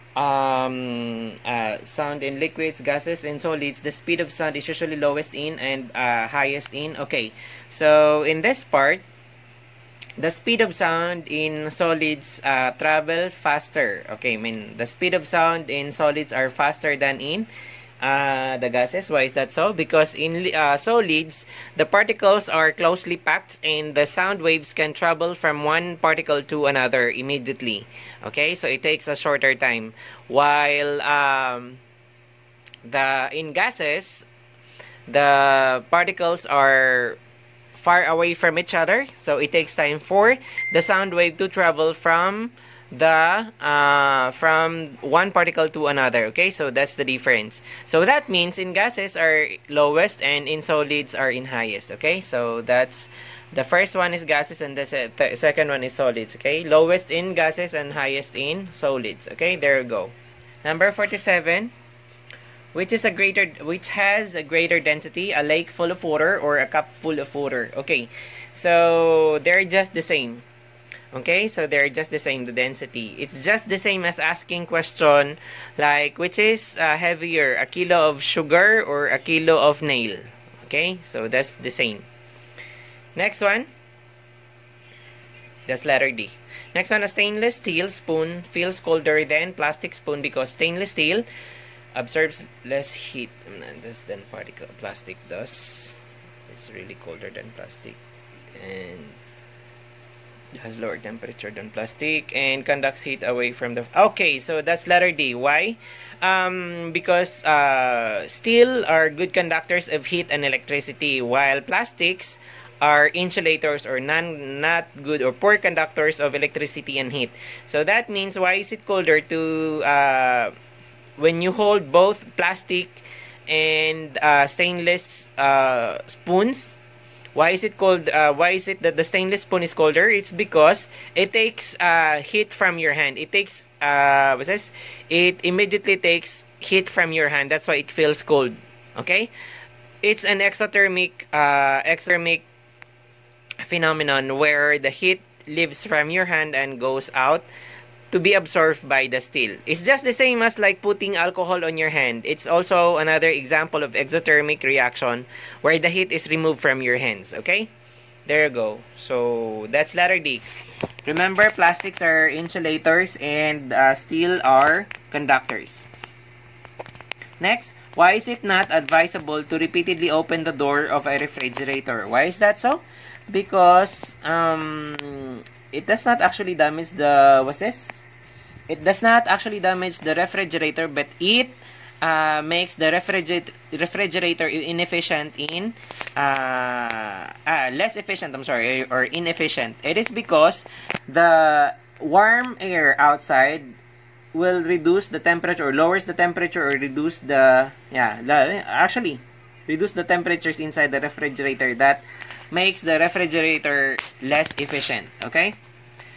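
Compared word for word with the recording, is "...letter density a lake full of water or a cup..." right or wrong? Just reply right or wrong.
wrong.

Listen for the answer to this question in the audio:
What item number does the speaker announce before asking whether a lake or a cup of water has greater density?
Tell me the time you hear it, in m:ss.
1:00.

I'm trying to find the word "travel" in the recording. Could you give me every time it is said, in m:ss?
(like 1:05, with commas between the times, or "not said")
0:12, 0:24, 0:41.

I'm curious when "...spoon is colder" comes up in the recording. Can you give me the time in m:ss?
2:09.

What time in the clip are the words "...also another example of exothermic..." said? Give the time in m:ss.
2:32.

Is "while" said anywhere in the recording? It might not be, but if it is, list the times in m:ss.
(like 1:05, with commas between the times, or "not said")
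0:30, 1:51.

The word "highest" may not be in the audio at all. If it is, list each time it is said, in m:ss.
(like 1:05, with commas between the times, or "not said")
0:06, 0:51, 0:57.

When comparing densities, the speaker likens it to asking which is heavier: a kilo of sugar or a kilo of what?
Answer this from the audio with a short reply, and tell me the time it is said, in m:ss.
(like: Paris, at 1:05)
nail, at 1:19.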